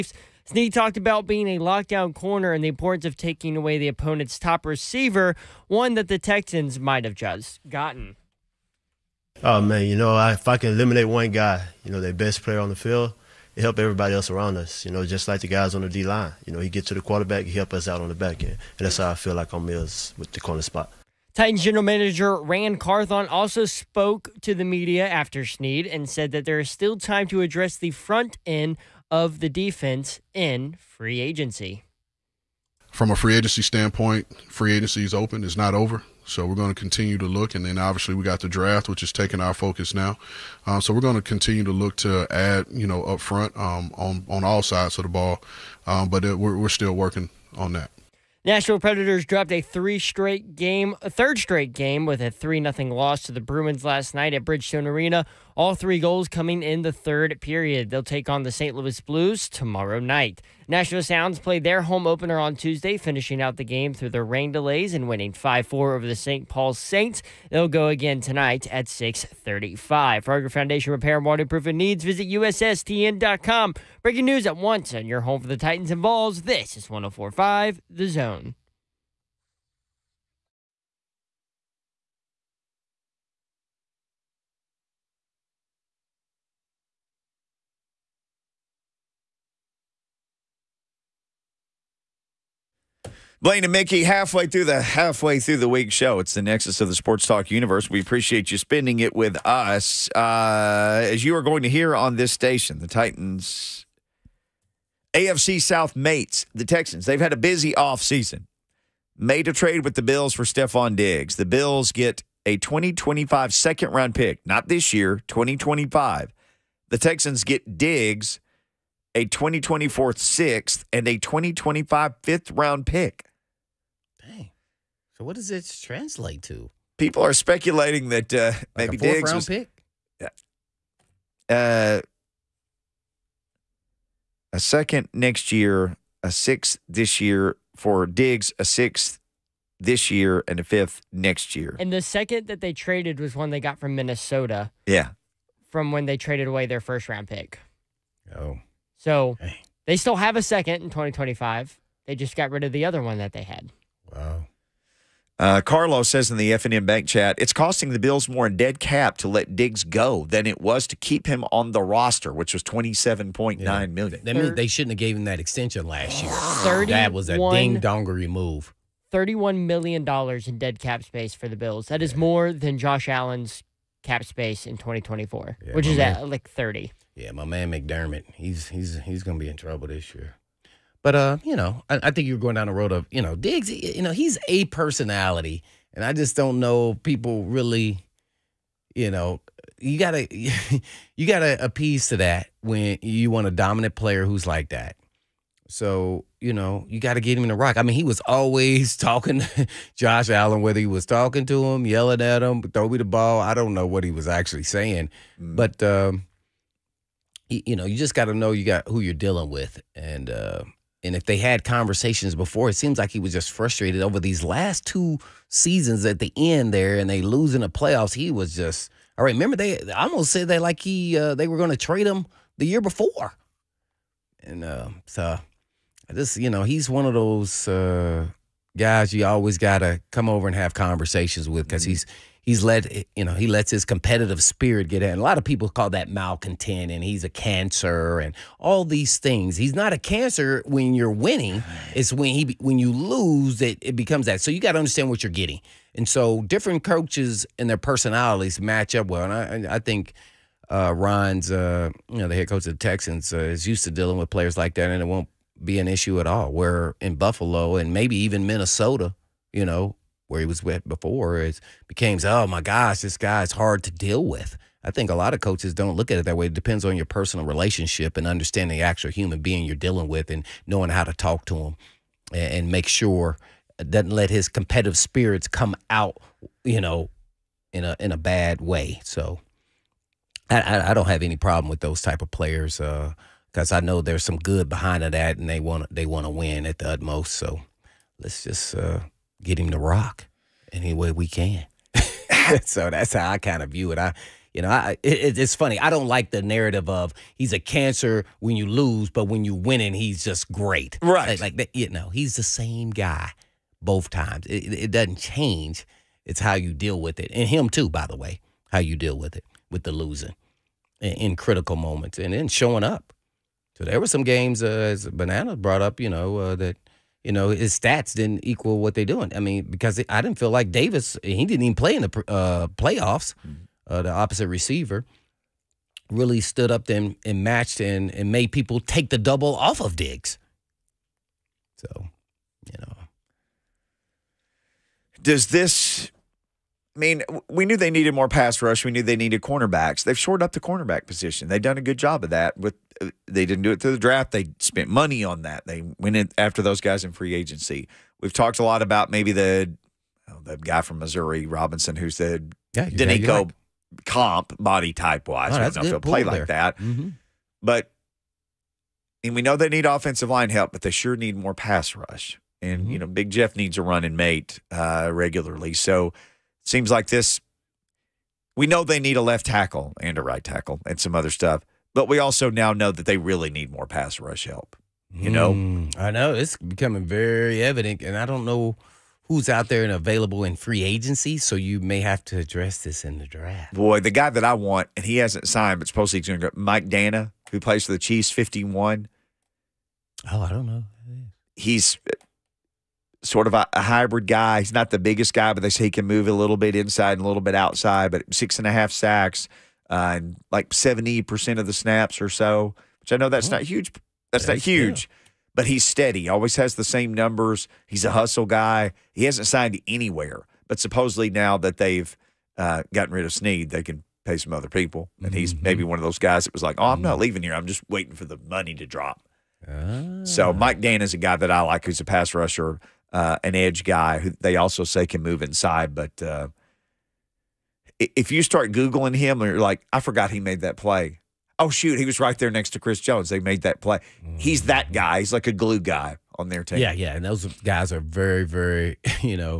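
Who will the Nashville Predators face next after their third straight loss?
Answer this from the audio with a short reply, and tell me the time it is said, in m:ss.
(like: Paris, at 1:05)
St. Louis Blues, at 0:58.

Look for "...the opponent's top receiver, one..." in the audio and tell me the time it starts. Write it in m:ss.
0:03.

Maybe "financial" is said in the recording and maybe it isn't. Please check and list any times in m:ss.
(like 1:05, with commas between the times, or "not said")
not said.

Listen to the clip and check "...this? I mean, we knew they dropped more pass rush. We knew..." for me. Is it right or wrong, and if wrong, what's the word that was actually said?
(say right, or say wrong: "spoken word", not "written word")
wrong: "needed", not "dropped".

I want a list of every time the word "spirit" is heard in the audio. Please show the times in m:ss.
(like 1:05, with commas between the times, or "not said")
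3:54, 4:34.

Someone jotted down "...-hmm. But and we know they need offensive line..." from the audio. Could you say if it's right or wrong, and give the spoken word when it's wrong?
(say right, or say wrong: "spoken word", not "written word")
right.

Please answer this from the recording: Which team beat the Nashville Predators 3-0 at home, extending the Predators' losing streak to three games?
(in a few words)
Bruins.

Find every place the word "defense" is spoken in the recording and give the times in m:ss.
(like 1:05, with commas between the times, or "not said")
0:29.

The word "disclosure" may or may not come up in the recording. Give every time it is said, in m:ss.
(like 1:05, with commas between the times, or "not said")
not said.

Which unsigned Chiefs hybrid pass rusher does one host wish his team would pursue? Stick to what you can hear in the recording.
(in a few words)
Mike Danna.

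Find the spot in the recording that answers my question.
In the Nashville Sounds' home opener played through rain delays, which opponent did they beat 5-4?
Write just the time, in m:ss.
1:06.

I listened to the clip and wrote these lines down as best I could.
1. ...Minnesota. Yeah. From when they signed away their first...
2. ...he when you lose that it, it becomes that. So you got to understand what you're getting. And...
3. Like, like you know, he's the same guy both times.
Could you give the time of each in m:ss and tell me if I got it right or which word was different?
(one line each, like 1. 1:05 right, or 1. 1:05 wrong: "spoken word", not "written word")
1. 2:23 wrong: "traded", not "signed"
2. 4:02 right
3. 5:01 right.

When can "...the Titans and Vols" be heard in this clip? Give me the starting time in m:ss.
1:15.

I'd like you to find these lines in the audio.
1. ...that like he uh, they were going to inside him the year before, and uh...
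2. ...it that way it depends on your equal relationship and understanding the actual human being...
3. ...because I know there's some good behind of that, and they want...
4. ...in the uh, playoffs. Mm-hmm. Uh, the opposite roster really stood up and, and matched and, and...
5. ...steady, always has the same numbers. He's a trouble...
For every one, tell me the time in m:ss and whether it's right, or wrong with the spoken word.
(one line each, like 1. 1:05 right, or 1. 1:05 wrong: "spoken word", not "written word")
1. 3:40 wrong: "trade", not "inside"
2. 4:26 wrong: "personal", not "equal"
3. 4:43 right
4. 5:21 wrong: "receiver", not "roster"
5. 6:45 wrong: "hustle", not "trouble".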